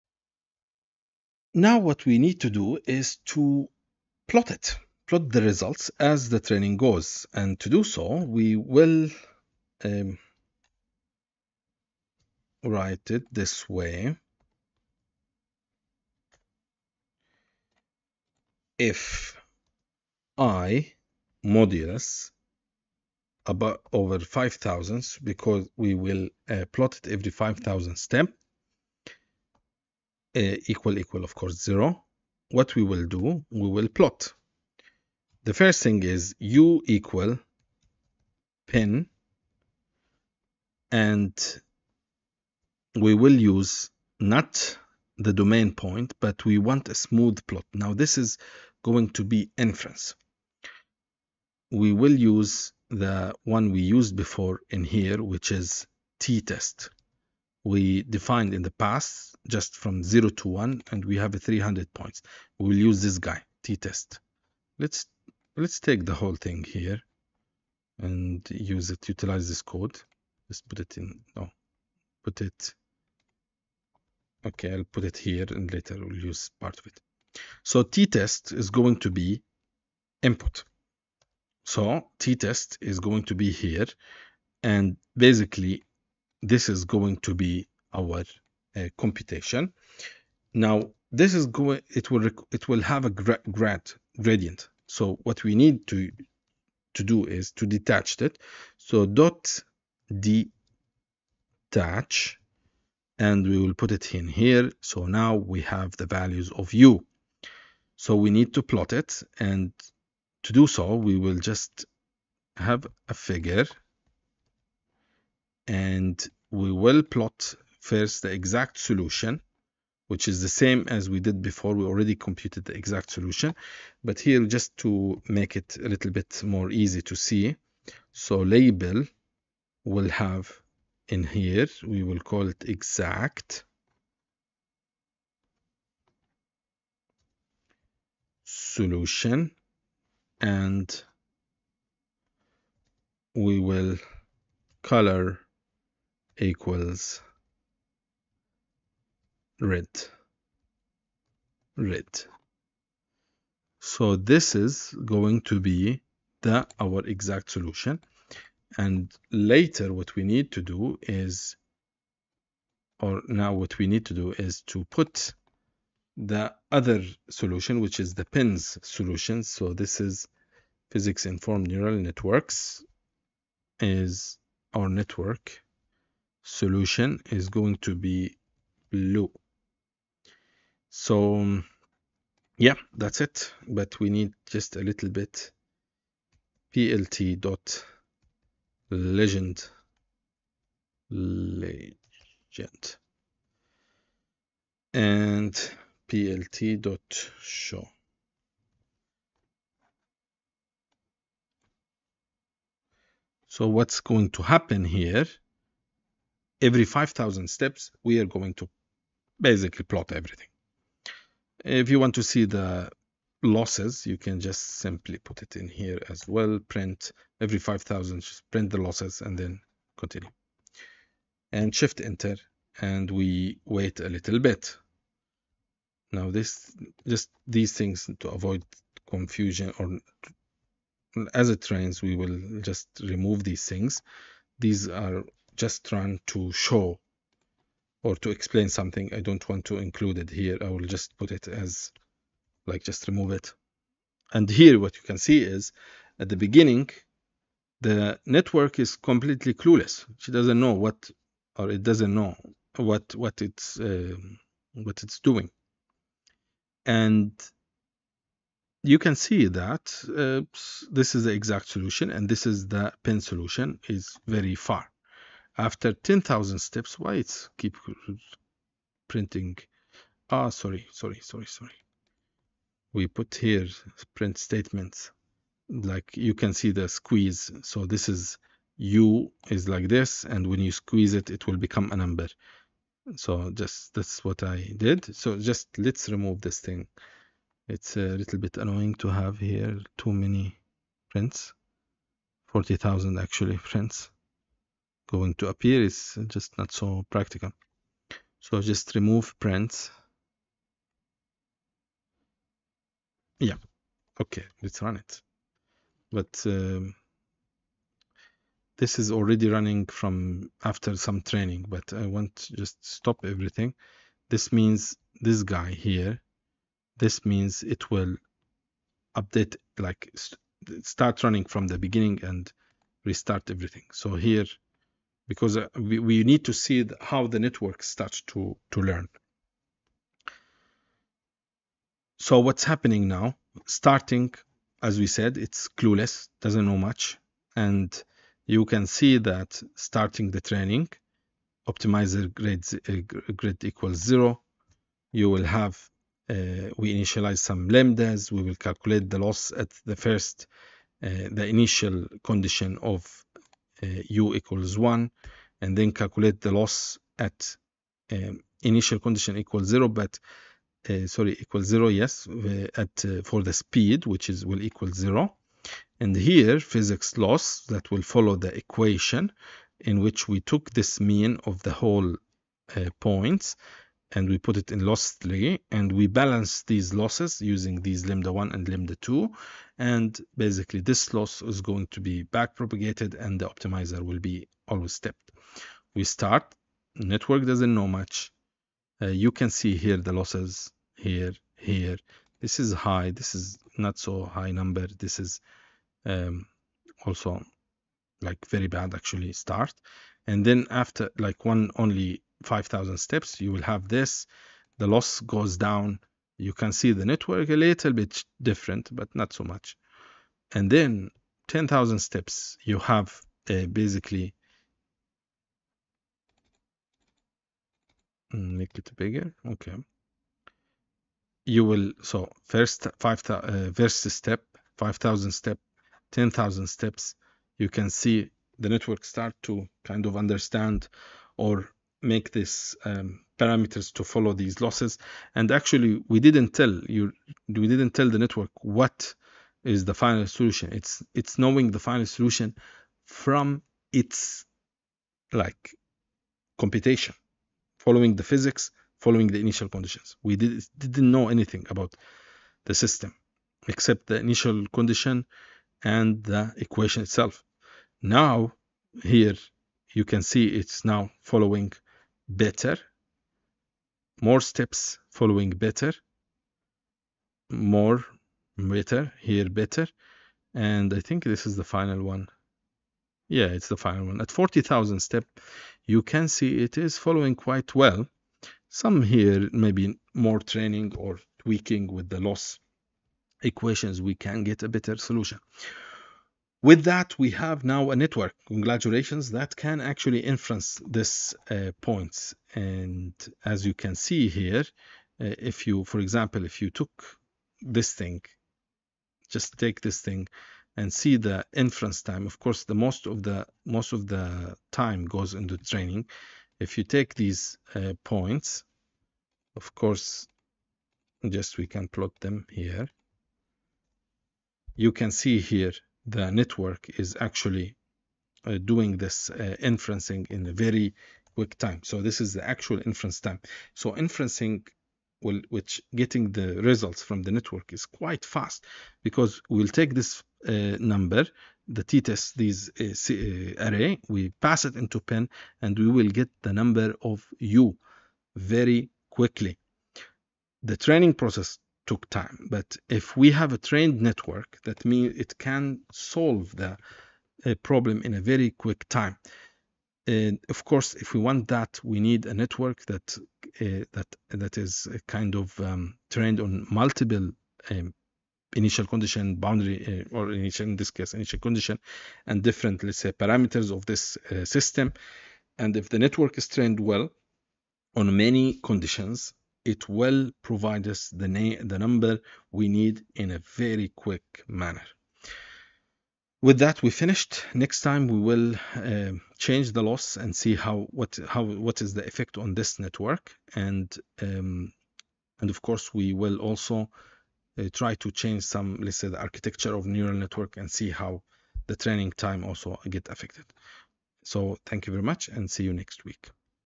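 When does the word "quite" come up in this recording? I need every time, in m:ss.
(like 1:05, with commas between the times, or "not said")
7:57, 8:47.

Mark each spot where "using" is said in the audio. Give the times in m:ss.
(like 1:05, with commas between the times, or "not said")
6:17.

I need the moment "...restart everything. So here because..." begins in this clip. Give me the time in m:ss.
5:23.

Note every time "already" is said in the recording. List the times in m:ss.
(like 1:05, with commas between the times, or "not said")
2:01, 5:09.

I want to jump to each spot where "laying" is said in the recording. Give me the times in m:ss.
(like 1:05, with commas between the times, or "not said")
not said.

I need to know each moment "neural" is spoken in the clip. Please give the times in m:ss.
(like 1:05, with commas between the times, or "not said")
2:51, 9:49.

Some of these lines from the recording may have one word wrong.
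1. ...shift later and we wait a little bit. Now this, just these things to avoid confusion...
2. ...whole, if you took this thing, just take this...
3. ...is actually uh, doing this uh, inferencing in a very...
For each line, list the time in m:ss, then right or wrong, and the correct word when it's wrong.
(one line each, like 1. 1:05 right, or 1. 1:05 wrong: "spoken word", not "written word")
1. 3:41 wrong: "enter", not "later"
2. 8:15 wrong: "example", not "whole"
3. 8:36 right.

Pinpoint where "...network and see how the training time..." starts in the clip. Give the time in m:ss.
9:50.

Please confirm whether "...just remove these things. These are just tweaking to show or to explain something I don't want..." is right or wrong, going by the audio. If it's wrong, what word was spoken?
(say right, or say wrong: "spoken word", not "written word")
wrong: "trying", not "tweaking".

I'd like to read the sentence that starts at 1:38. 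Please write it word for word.
So dot detach, and we will put it in here.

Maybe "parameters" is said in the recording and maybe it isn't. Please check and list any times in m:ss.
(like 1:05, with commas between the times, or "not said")
7:13, 9:23.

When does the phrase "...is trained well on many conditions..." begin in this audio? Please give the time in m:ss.
9:26.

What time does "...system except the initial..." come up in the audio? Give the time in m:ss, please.
7:32.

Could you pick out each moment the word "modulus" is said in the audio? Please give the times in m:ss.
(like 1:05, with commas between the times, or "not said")
0:21.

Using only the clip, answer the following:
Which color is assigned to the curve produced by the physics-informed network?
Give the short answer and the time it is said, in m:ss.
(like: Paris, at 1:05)
Blue, at 2:58.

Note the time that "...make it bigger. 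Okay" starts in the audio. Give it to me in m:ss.
6:58.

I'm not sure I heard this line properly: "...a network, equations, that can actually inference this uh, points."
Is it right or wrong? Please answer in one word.
wrong.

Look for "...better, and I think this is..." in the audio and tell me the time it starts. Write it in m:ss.
7:49.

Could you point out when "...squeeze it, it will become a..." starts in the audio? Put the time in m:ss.
4:40.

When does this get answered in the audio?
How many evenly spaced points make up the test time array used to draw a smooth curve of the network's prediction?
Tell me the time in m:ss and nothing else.
1:01.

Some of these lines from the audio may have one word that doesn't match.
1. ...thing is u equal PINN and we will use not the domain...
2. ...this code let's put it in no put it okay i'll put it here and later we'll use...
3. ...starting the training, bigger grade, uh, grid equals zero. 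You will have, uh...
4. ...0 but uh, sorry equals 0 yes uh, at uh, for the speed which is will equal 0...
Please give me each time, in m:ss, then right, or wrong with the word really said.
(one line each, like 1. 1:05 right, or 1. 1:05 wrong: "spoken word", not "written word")
1. 0:35 right
2. 1:09 right
3. 5:39 wrong: "optimizer", not "bigger"
4. 5:59 right.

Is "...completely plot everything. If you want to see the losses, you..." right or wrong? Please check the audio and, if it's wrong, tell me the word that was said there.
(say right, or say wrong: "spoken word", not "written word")
wrong: "basically", not "completely".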